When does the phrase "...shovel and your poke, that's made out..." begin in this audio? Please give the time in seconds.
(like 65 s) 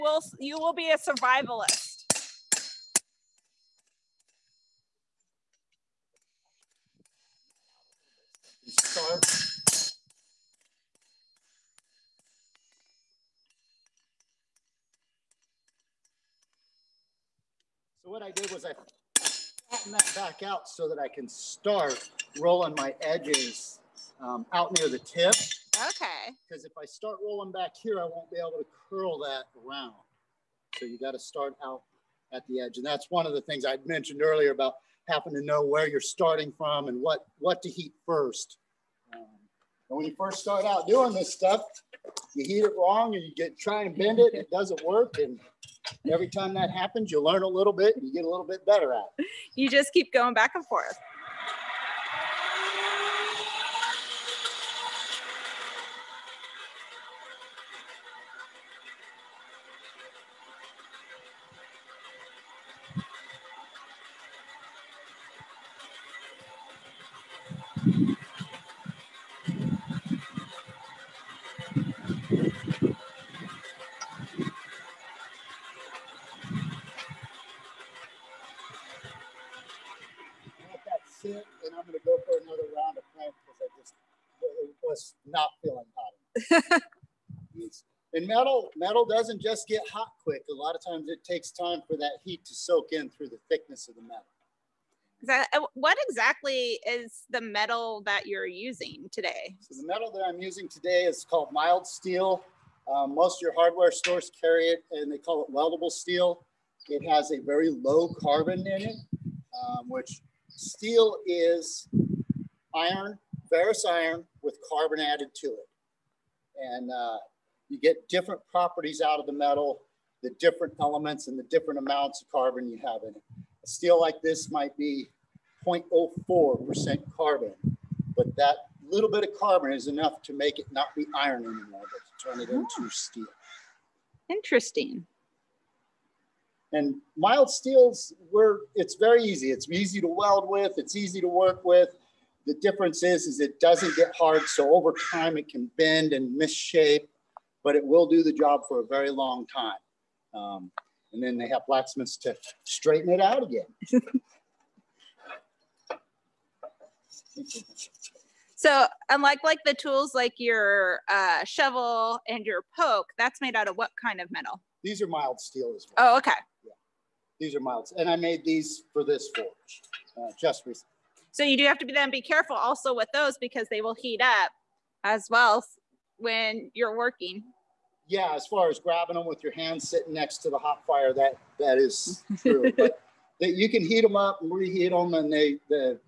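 161 s.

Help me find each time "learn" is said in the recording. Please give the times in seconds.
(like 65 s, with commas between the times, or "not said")
47 s.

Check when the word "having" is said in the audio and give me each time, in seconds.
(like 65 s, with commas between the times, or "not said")
35 s.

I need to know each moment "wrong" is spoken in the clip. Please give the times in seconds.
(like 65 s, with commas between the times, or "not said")
42 s.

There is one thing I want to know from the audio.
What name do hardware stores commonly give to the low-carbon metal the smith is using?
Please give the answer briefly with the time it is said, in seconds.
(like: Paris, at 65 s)
Weldable steel, at 105 s.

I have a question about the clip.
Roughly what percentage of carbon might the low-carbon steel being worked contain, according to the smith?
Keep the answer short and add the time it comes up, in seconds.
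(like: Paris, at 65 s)
0.04%, at 125 s.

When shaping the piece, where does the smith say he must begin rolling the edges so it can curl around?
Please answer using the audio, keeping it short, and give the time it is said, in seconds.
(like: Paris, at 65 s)
Near the tip, at 24 s.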